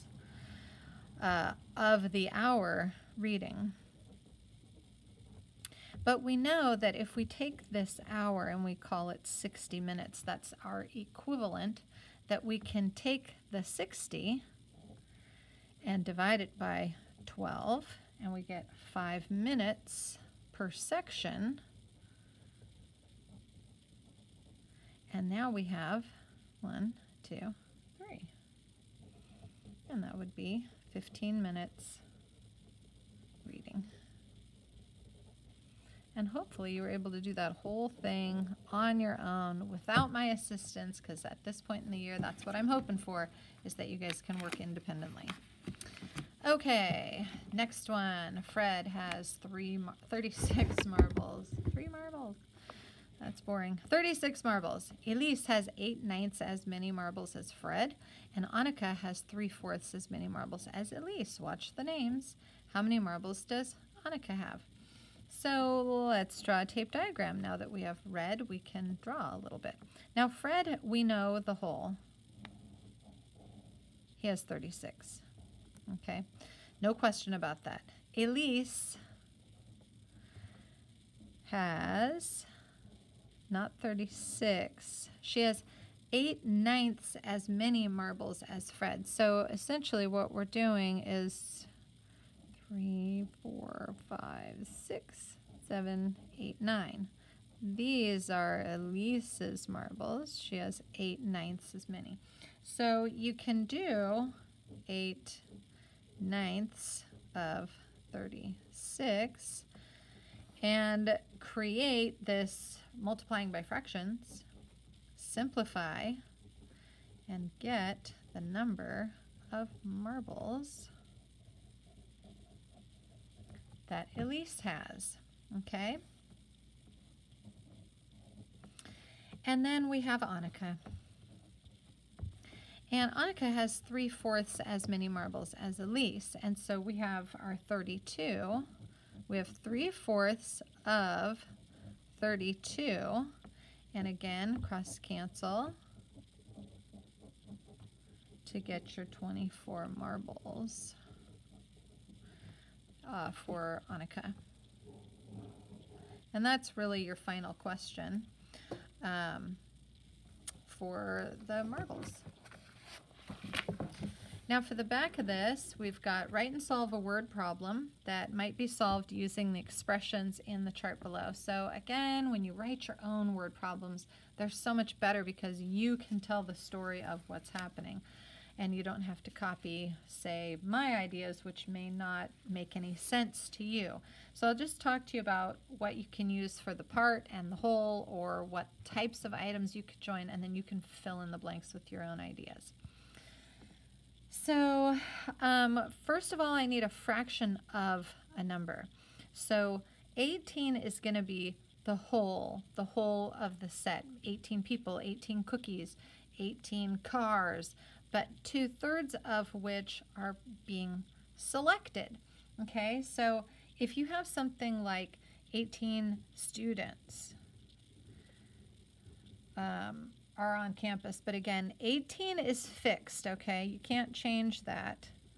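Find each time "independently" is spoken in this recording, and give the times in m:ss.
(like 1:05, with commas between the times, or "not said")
0:44.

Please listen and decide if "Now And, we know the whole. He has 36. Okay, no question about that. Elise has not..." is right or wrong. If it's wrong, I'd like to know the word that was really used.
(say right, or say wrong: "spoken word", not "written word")
wrong: "Fred", not "And".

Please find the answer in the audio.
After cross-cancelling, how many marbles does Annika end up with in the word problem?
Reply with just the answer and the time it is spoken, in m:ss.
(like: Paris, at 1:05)
24, at 2:29.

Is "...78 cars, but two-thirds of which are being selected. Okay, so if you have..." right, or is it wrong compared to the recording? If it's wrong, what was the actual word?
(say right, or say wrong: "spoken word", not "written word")
wrong: "18", not "78".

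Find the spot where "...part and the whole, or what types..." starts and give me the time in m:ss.
3:06.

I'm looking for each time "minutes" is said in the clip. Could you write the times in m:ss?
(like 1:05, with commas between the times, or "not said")
0:09, 0:19, 0:31.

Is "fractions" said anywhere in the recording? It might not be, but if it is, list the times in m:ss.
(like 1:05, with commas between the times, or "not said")
1:53, 3:16.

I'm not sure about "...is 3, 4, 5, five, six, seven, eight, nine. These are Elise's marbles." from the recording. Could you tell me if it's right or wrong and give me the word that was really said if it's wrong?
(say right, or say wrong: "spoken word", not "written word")
right.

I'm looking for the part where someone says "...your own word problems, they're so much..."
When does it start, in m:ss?
2:52.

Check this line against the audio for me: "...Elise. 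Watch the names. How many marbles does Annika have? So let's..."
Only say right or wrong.
right.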